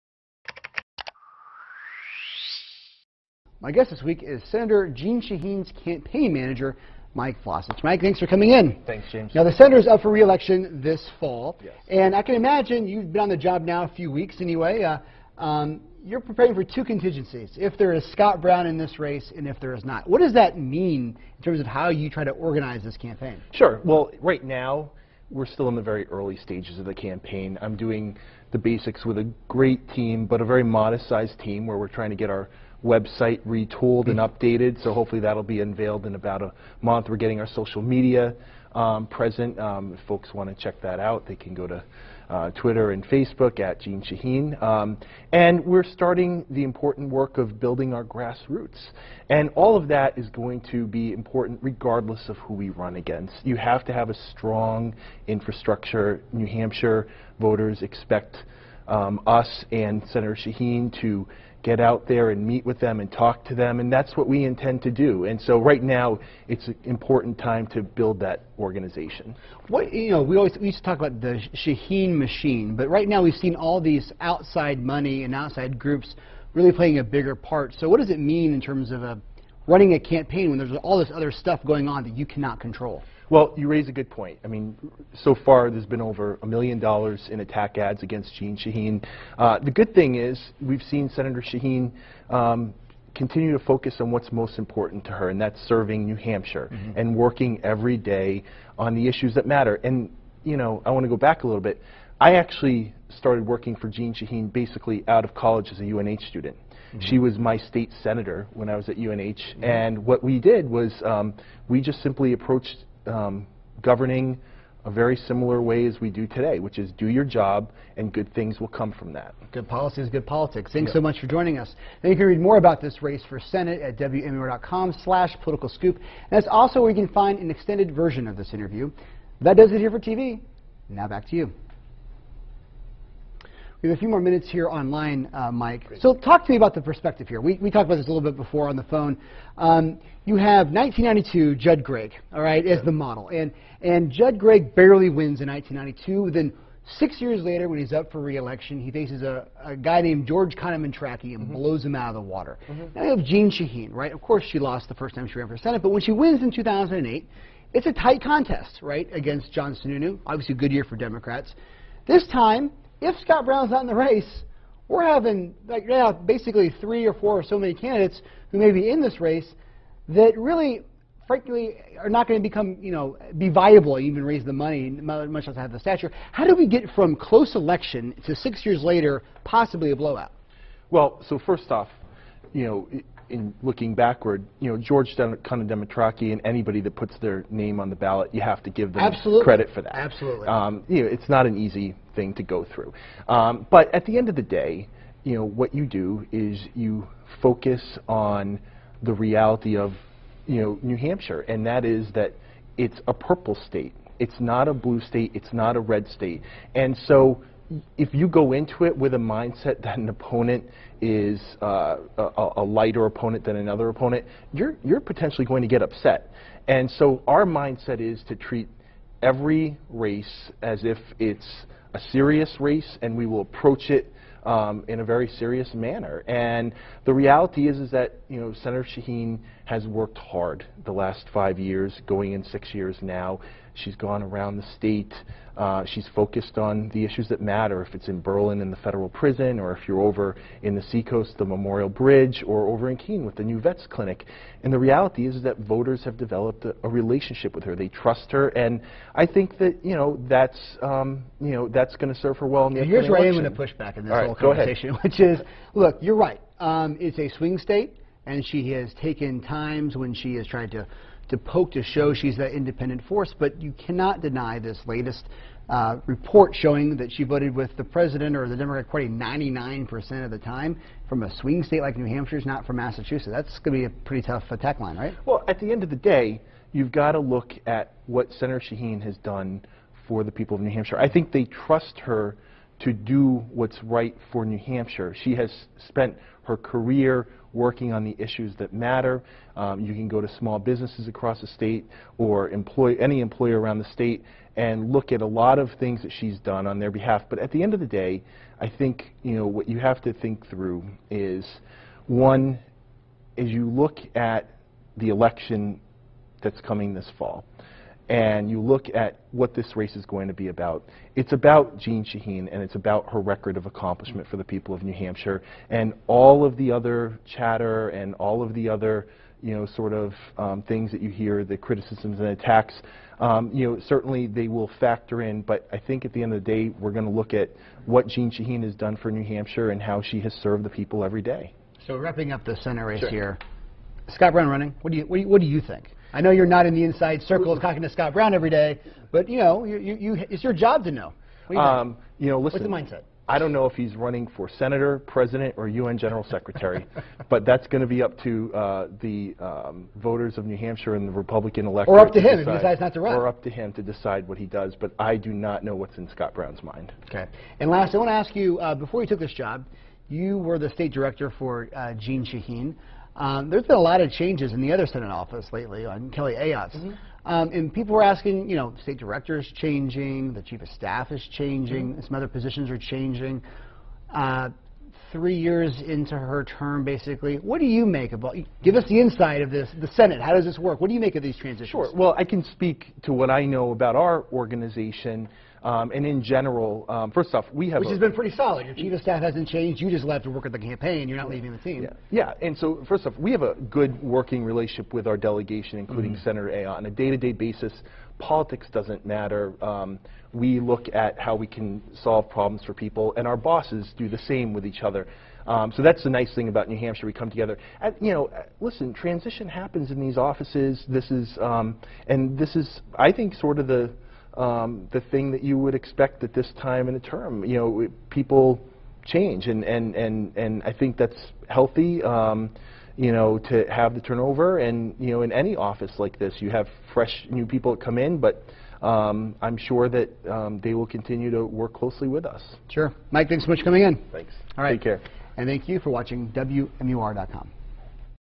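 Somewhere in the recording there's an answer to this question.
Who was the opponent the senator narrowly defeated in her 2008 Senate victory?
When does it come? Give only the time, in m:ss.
2:39.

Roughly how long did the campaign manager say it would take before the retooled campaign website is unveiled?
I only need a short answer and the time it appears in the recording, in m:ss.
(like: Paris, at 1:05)
about a month, at 0:36.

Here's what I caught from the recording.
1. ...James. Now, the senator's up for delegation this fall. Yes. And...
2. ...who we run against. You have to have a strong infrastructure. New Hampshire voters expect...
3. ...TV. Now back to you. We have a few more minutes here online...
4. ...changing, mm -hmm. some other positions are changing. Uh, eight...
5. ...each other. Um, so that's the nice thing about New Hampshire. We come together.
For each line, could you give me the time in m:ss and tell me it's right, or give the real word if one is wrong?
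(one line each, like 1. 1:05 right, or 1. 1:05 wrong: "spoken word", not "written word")
1. 0:09 wrong: "reelection", not "delegation"
2. 0:52 right
3. 2:09 right
4. 6:11 wrong: "three", not "eight"
5. 6:44 right.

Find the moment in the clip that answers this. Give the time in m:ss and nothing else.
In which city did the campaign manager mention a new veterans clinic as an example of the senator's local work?
4:02.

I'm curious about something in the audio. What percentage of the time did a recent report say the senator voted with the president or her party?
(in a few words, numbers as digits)
99%.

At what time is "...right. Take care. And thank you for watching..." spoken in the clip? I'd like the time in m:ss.
7:14.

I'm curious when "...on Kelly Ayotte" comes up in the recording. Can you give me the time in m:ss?
6:05.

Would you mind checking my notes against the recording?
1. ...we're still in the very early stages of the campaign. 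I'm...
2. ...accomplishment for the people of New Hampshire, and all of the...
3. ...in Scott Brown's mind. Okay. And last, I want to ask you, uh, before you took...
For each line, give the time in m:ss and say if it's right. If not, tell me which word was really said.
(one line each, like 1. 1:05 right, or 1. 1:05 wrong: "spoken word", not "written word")
1. 0:25 right
2. 5:13 right
3. 5:55 right.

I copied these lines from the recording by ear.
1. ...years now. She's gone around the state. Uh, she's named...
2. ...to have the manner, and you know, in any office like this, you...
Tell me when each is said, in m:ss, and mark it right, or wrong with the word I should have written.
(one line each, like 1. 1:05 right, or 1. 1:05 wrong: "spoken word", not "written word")
1. 3:52 wrong: "focused", not "named"
2. 7:03 wrong: "turnover", not "manner".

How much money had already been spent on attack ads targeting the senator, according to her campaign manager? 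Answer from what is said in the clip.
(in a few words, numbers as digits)
over a million dollars.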